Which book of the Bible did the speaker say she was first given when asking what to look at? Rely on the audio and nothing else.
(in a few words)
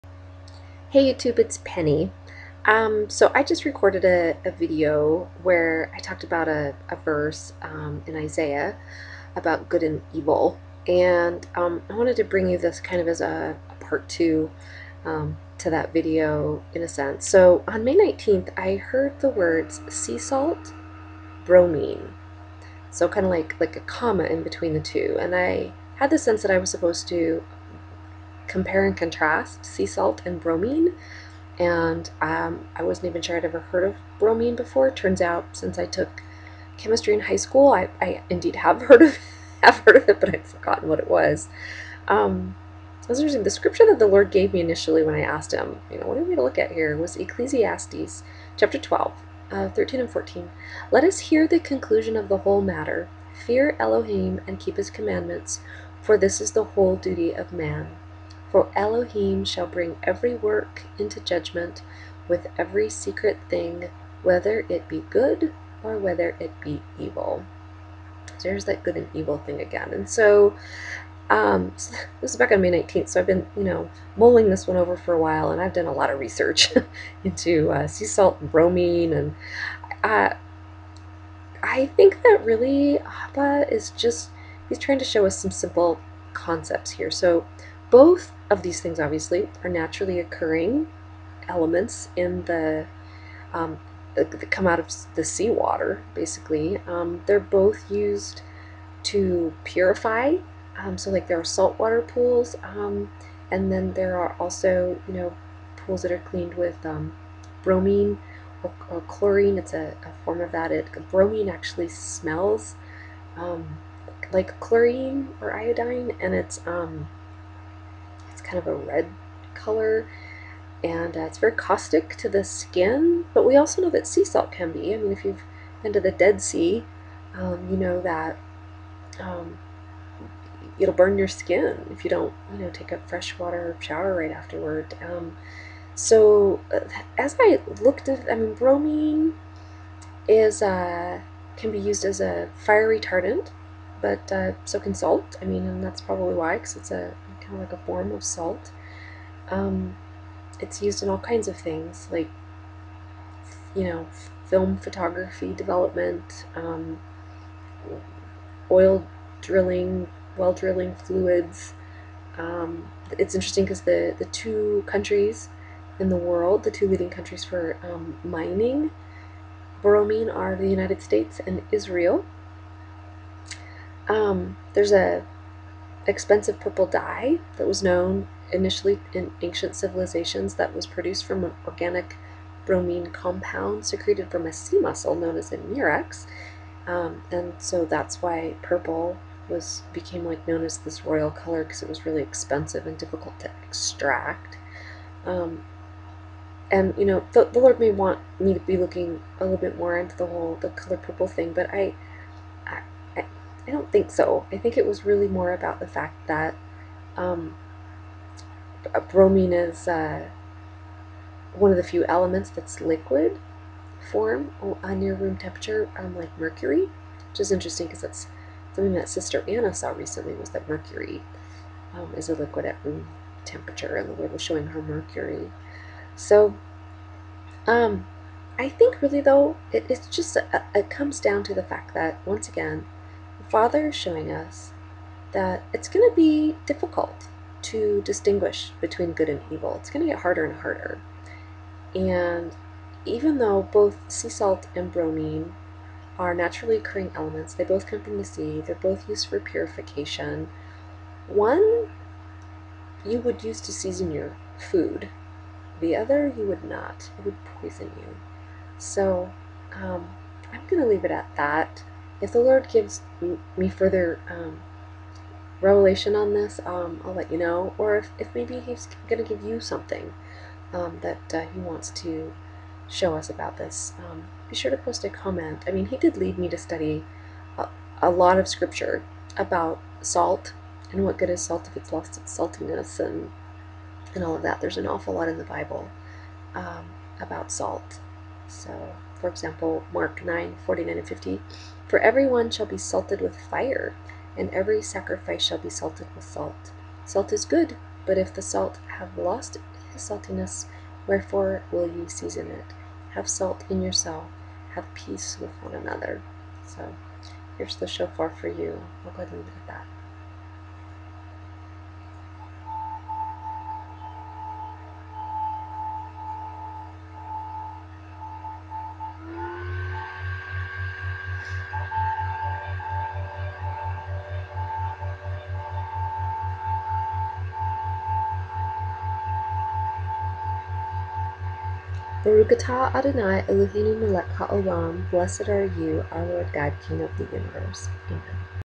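Ecclesiastes.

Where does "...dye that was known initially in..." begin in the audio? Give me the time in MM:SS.
02:56.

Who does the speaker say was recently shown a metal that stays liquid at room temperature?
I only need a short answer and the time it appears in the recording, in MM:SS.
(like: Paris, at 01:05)
Sister Anna, at 03:39.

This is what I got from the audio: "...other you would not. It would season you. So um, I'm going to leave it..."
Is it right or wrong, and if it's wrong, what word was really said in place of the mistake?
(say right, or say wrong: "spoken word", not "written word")
wrong: "poison", not "season".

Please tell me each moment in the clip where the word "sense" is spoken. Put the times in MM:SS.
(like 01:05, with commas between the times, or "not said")
00:16, 00:26.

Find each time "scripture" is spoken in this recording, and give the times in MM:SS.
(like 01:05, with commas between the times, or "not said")
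00:43, 04:38.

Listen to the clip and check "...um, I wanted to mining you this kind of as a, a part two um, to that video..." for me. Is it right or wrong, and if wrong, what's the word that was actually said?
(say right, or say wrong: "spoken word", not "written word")
wrong: "bring", not "mining".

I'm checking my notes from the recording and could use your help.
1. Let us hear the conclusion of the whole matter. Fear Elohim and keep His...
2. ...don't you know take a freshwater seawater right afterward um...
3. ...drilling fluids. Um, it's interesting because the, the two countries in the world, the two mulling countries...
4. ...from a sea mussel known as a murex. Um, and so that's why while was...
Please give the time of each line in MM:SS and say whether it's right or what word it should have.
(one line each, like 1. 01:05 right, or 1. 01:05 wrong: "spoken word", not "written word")
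1. 00:50 right
2. 02:12 wrong: "shower", not "seawater"
3. 02:40 wrong: "leading", not "mulling"
4. 03:04 wrong: "purple", not "while".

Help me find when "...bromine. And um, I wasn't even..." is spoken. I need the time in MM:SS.
00:30.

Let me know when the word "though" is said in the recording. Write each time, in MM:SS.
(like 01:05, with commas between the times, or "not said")
03:49, 04:03.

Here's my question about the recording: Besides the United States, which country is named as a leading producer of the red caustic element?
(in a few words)
Israel.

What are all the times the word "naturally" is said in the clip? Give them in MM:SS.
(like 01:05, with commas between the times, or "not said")
01:29, 04:06.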